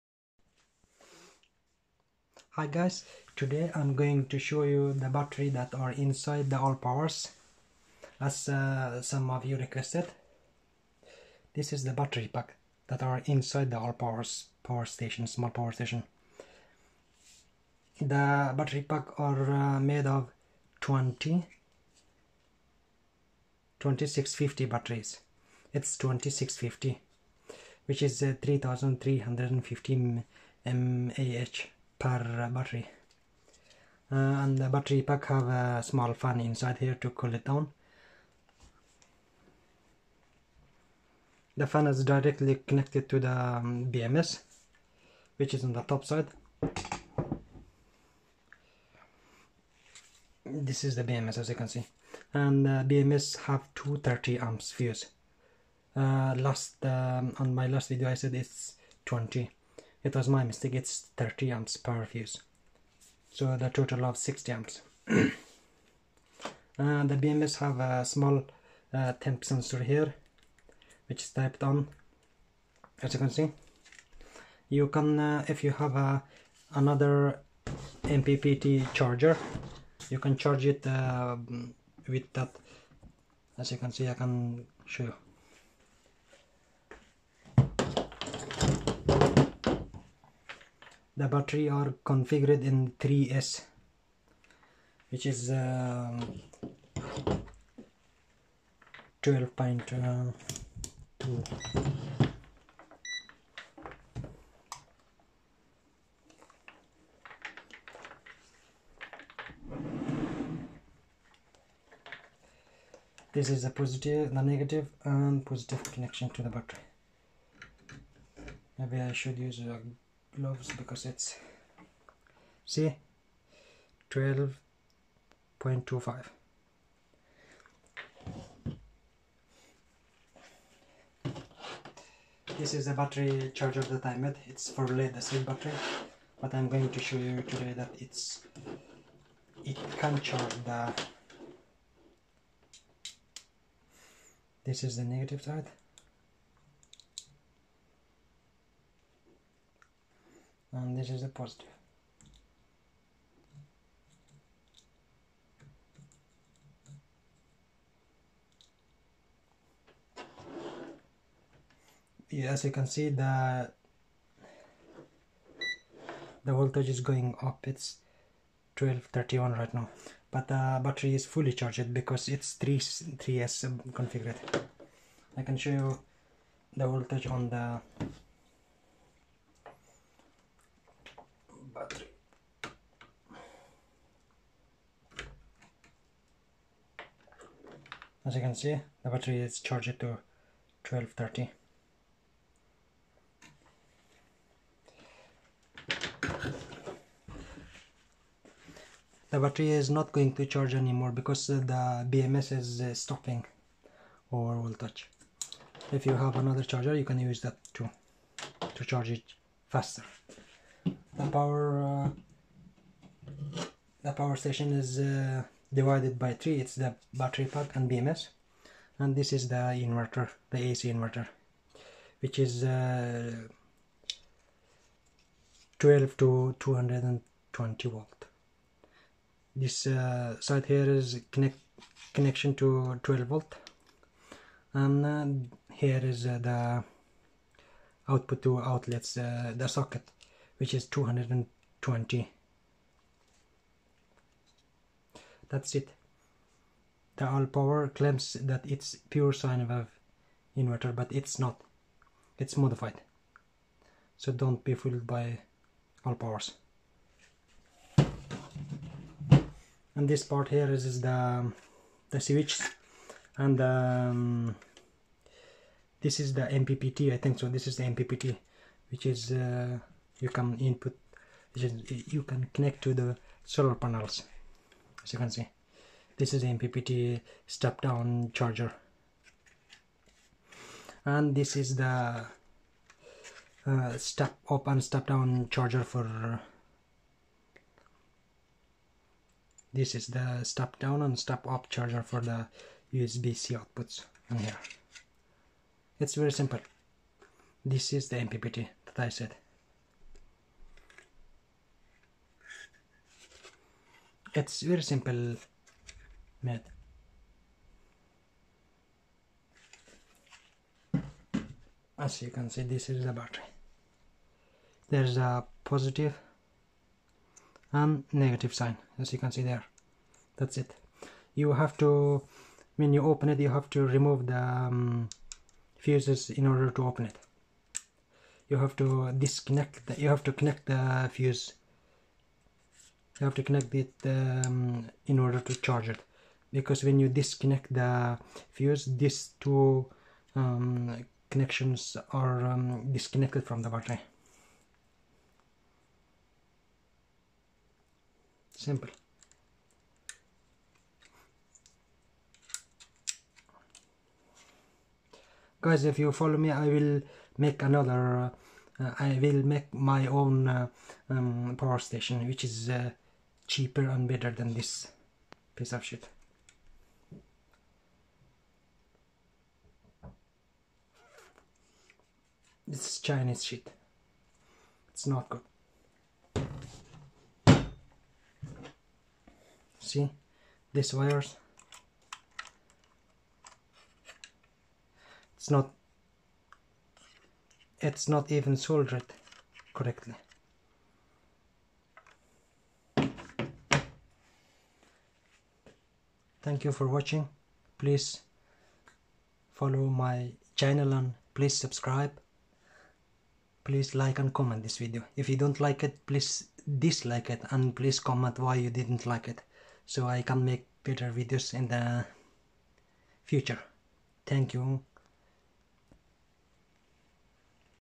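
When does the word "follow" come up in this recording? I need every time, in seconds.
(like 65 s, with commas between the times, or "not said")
356 s, 399 s.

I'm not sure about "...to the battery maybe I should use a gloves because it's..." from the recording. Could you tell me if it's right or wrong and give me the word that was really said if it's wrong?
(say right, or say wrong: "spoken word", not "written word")
right.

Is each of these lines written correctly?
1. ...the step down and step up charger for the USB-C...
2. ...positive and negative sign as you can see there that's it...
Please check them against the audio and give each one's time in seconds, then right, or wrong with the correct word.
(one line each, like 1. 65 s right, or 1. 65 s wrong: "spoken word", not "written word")
1. 290 s right
2. 315 s right.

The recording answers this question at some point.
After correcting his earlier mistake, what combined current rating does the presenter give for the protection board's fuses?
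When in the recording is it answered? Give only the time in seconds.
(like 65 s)
64 s.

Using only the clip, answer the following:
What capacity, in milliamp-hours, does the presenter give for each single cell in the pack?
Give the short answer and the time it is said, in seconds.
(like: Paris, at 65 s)
3350 mAh, at 28 s.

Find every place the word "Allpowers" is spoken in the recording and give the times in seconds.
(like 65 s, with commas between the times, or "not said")
6 s, 13 s, 247 s, 256 s.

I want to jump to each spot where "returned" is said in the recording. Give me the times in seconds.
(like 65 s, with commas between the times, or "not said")
not said.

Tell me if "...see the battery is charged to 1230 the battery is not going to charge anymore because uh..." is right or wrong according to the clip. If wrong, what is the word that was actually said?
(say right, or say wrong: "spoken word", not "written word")
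right.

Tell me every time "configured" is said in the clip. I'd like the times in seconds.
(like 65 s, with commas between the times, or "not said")
92 s, 173 s.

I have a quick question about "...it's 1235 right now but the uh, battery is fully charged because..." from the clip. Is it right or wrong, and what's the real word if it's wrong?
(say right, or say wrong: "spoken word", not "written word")
wrong: "1231", not "1235".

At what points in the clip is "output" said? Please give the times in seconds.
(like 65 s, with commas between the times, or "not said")
238 s, 293 s.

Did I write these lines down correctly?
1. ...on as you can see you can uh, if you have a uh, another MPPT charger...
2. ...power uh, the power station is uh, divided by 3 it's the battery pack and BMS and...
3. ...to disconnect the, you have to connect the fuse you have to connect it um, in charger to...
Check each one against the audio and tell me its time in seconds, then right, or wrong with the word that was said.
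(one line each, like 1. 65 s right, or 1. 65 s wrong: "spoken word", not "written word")
1. 71 s right
2. 211 s right
3. 328 s wrong: "order", not "charger".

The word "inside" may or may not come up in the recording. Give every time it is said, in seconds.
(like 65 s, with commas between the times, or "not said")
5 s, 13 s, 36 s.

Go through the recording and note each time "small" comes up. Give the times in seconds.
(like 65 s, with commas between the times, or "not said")
15 s, 35 s, 68 s.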